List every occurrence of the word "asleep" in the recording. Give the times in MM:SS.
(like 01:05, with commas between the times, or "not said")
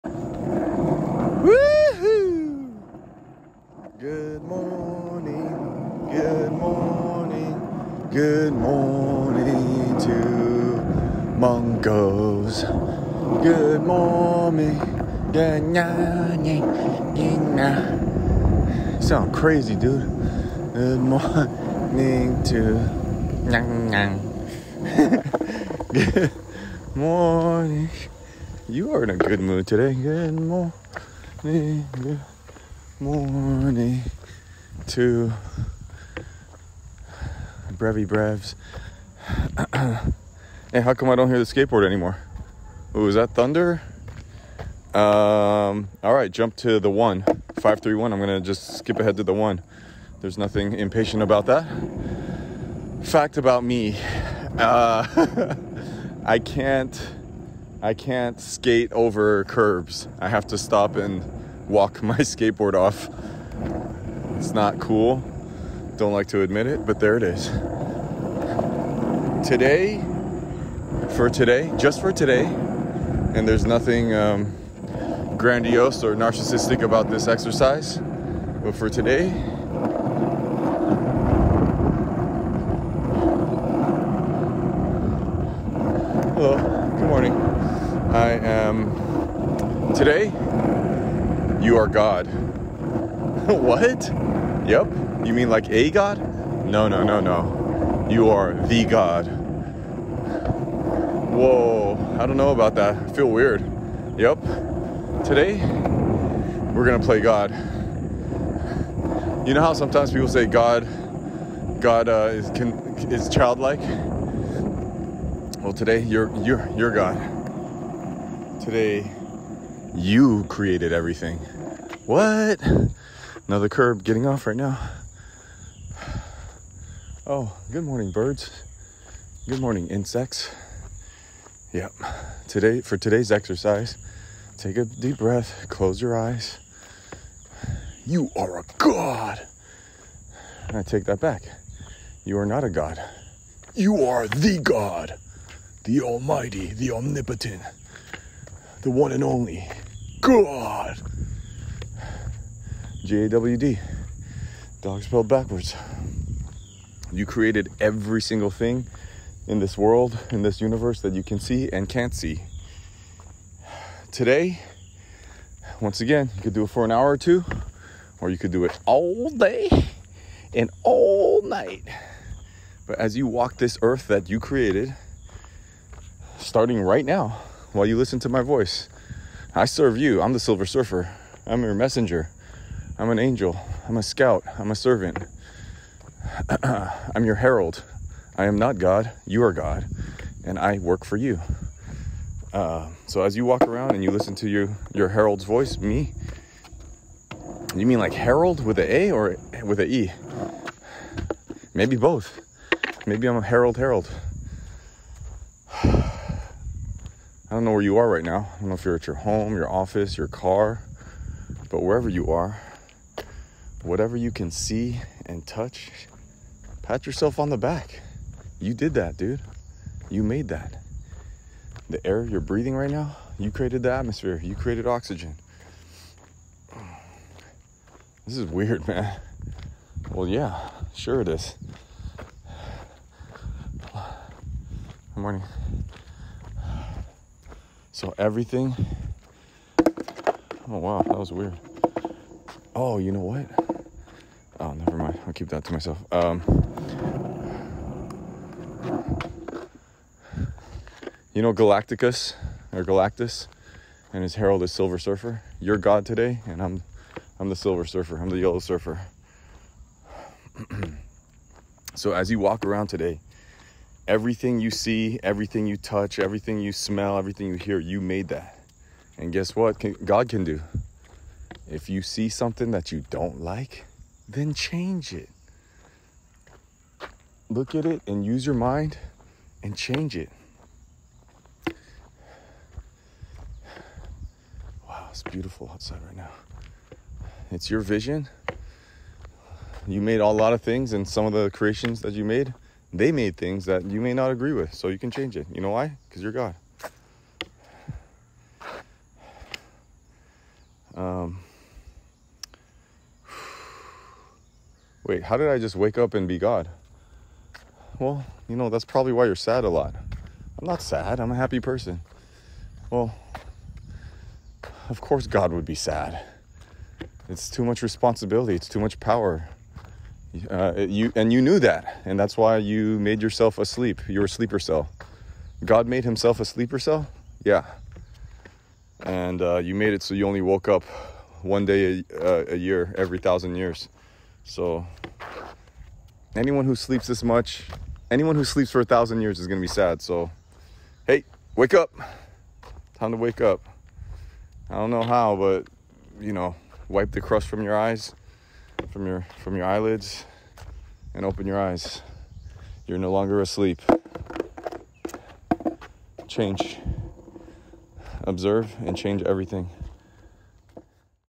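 05:23, 05:53.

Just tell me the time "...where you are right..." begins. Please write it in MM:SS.
03:27.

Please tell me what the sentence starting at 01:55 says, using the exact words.
Well, today you're you're you're God.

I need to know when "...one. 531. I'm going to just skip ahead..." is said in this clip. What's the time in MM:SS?
00:46.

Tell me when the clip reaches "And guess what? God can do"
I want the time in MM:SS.
04:29.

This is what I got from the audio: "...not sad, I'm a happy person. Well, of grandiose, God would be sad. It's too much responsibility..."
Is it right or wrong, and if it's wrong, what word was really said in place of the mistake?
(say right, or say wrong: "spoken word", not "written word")
wrong: "course", not "grandiose".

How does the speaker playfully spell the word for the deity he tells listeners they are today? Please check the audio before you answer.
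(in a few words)
J-A-W-D.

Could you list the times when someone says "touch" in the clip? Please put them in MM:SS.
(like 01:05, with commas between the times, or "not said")
03:35, 04:25.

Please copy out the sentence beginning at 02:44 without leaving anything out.
Today, once again, you could do it for an hour or two, or you could do it all day and all night.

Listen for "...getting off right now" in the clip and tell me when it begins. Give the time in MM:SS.
02:04.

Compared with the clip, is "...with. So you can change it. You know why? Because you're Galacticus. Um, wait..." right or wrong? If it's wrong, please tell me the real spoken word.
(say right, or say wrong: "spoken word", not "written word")
wrong: "God", not "Galacticus".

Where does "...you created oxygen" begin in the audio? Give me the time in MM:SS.
03:44.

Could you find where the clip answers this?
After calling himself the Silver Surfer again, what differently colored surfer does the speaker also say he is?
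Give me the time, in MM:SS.
04:18.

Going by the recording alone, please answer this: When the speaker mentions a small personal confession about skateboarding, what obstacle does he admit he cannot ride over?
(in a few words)
curbs.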